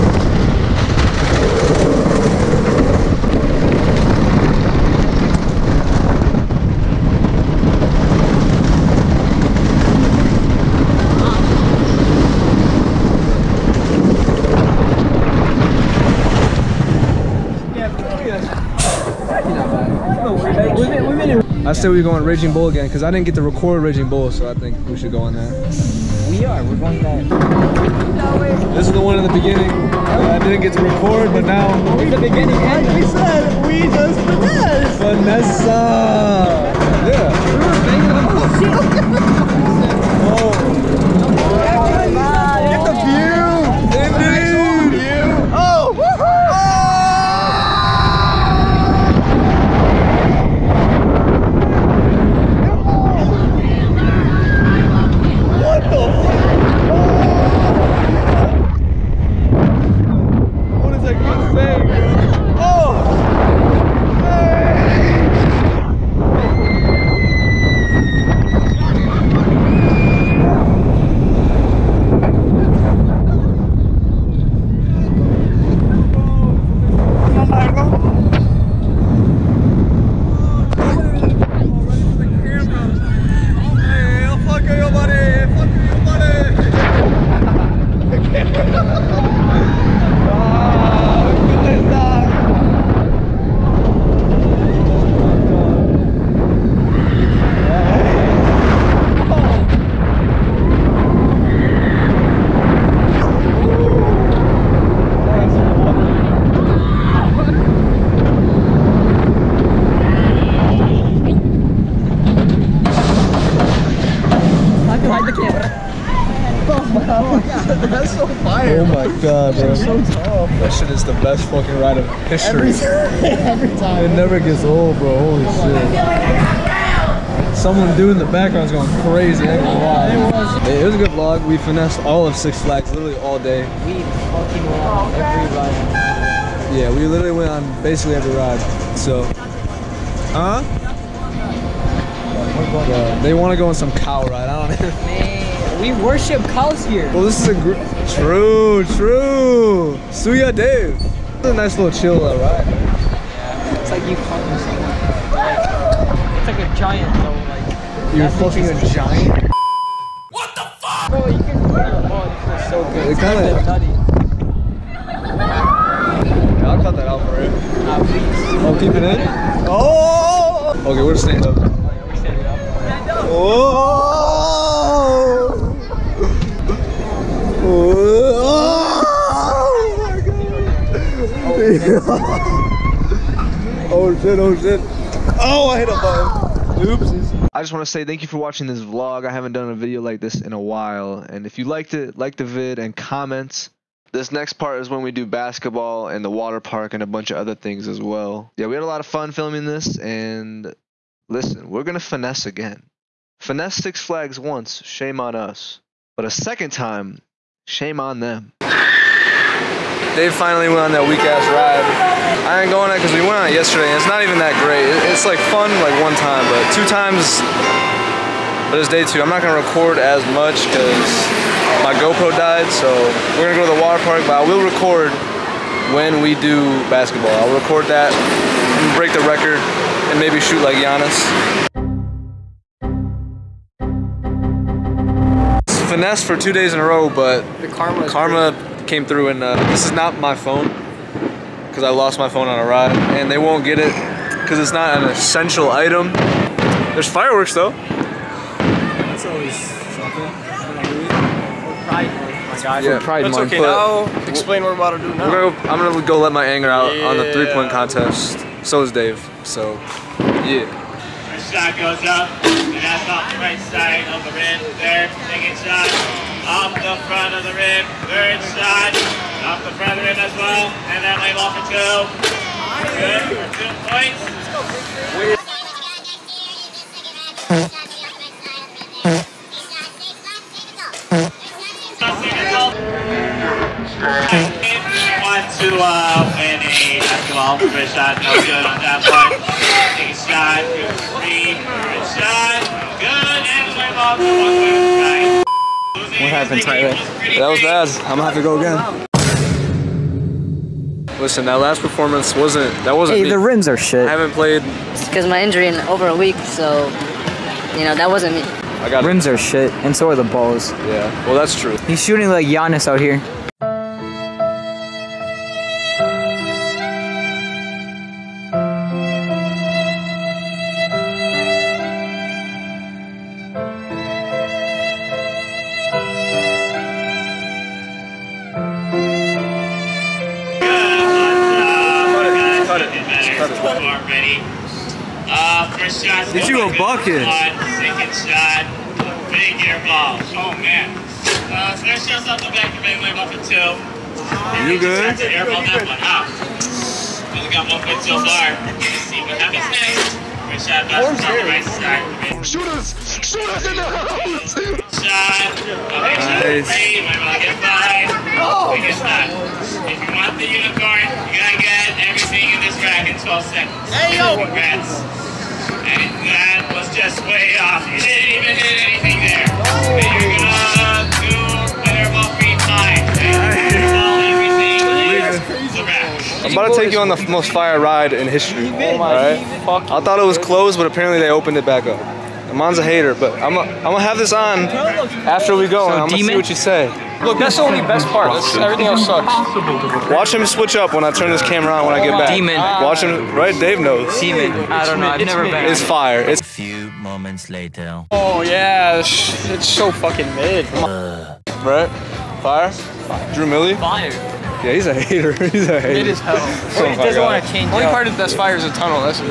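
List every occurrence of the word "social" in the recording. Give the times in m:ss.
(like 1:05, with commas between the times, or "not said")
not said.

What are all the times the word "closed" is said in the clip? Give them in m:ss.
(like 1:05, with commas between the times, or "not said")
6:20.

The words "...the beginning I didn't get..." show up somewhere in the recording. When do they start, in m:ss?
0:29.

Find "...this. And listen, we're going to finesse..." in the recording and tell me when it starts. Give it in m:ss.
3:19.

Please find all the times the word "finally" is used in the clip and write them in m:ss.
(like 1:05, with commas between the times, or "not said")
3:30.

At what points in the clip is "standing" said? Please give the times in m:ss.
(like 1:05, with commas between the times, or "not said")
2:51.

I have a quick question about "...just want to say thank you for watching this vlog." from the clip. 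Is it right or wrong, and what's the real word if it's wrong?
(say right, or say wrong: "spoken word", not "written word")
right.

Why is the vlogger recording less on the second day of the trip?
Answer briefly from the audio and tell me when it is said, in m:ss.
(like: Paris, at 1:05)
GoPro died, at 3:41.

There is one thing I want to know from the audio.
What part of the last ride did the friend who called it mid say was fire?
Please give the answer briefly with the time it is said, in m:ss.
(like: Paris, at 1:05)
the tunnel, at 6:48.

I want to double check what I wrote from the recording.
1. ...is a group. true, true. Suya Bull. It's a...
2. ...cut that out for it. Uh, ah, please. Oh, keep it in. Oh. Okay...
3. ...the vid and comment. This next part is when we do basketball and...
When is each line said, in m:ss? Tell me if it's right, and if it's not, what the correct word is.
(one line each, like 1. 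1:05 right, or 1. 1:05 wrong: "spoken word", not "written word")
1. 2:27 wrong: "Dave", not "Bull"
2. 2:46 right
3. 3:12 right.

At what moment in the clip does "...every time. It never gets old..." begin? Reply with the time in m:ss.
2:03.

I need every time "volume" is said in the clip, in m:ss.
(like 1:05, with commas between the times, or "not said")
not said.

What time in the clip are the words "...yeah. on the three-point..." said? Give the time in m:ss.
4:16.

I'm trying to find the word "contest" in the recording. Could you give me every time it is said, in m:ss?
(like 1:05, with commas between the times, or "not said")
4:17.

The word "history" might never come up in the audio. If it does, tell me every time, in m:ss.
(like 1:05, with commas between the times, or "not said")
2:02, 6:18.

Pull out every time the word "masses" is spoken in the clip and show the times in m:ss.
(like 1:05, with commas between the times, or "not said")
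not said.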